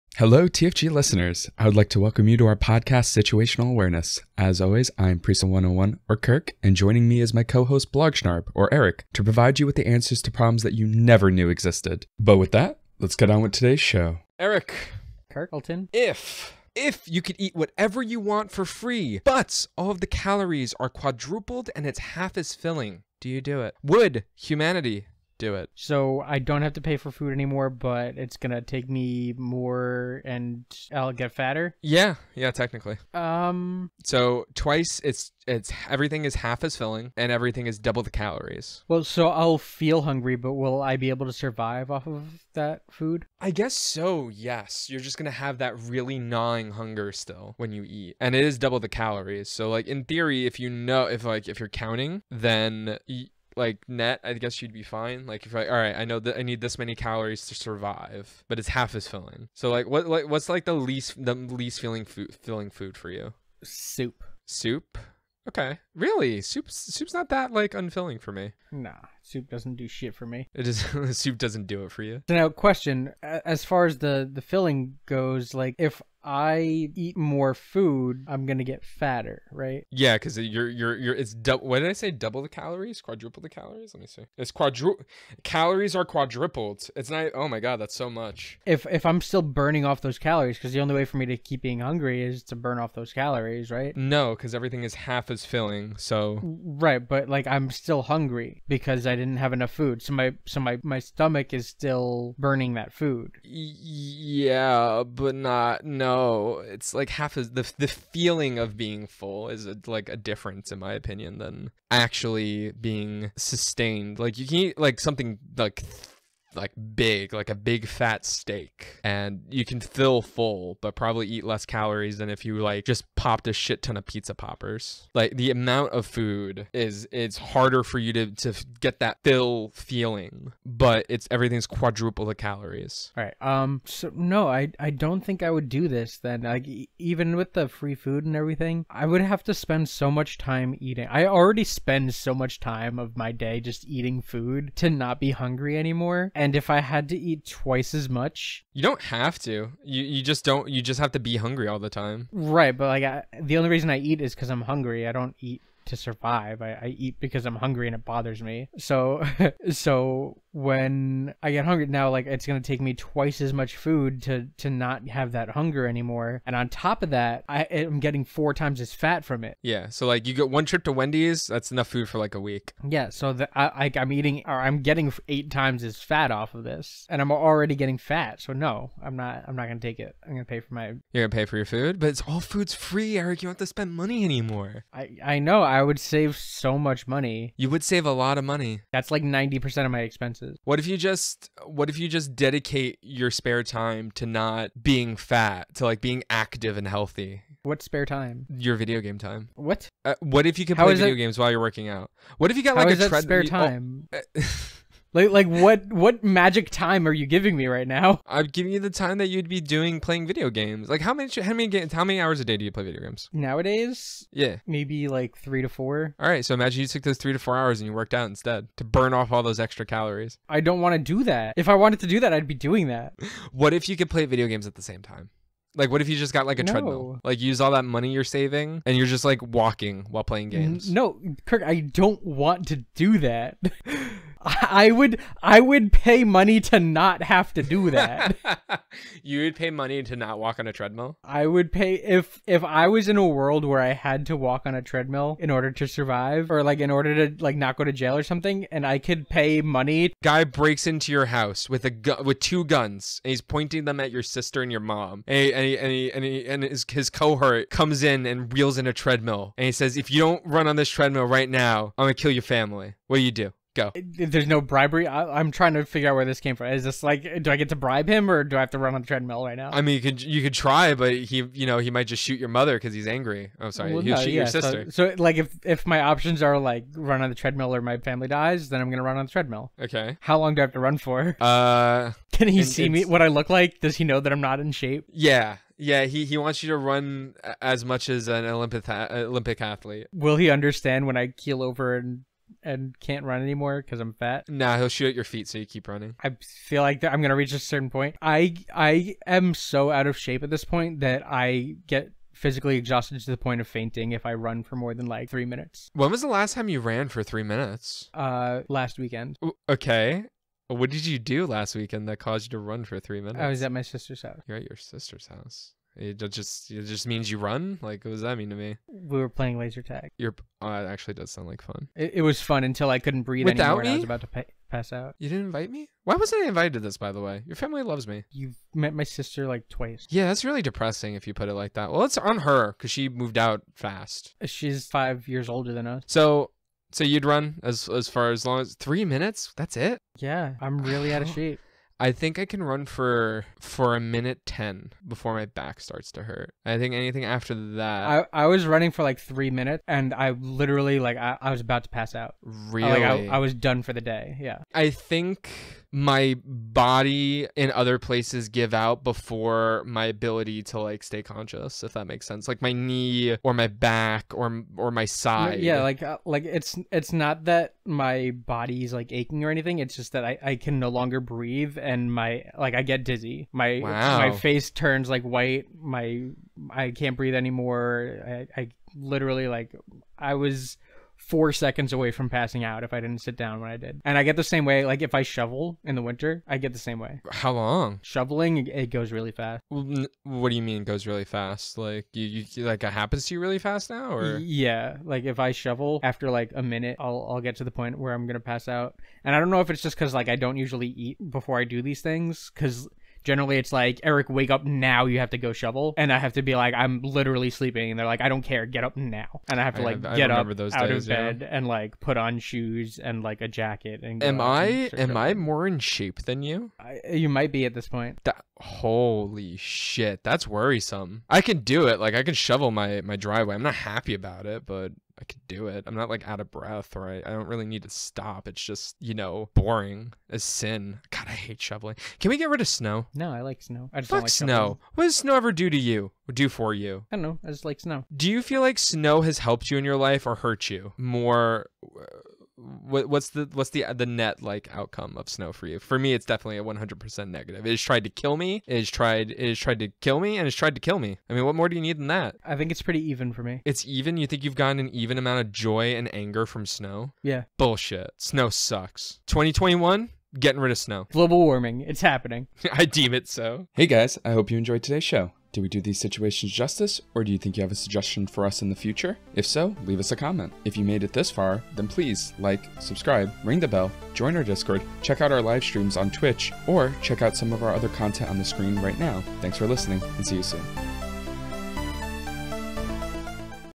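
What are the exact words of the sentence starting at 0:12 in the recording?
But with that, let's get on with today's show.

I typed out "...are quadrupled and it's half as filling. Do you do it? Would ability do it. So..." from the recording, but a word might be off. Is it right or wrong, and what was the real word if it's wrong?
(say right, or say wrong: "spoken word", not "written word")
wrong: "humanity", not "ability".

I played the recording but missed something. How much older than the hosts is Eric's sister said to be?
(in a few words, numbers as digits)
5 years.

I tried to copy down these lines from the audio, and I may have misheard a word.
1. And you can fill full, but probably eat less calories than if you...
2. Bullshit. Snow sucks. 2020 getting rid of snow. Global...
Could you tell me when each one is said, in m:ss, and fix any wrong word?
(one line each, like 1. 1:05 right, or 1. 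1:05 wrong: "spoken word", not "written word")
1. 1:59 right
2. 7:37 wrong: "2021", not "2020".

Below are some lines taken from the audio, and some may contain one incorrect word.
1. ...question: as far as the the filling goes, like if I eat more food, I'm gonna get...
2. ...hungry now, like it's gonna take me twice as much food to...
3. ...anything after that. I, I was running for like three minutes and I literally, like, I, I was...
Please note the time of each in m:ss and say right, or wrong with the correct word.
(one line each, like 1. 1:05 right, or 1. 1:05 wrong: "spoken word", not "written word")
1. 1:12 right
2. 2:41 right
3. 5:46 right.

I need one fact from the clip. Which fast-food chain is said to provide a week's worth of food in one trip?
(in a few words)
Wendy's.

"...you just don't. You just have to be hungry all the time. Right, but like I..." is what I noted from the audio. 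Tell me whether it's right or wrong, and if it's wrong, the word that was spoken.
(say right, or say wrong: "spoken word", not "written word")
right.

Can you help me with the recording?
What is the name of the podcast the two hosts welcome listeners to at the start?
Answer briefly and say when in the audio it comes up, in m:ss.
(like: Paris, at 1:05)
Situational Awareness, at 0:03.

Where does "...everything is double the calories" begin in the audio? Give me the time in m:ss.
0:37.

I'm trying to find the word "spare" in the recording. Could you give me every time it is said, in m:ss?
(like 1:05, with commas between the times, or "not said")
3:13, 3:17, 3:23.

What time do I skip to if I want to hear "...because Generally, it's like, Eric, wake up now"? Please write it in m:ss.
6:42.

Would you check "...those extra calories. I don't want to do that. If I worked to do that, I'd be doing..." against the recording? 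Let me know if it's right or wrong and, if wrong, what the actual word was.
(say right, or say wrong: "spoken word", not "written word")
wrong: "wanted", not "worked".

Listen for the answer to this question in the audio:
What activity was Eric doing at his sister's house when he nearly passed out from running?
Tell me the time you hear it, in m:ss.
5:19.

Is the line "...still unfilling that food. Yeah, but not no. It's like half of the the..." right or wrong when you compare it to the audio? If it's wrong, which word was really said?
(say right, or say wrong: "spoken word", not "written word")
wrong: "burning", not "unfilling".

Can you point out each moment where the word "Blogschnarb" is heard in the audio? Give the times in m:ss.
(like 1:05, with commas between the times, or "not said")
0:07.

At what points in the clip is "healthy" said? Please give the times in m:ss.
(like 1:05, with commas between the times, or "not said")
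3:16.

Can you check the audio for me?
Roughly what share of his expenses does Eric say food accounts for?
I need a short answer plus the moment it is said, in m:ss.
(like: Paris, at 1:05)
90 percent, at 3:09.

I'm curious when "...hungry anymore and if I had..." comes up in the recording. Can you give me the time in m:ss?
2:25.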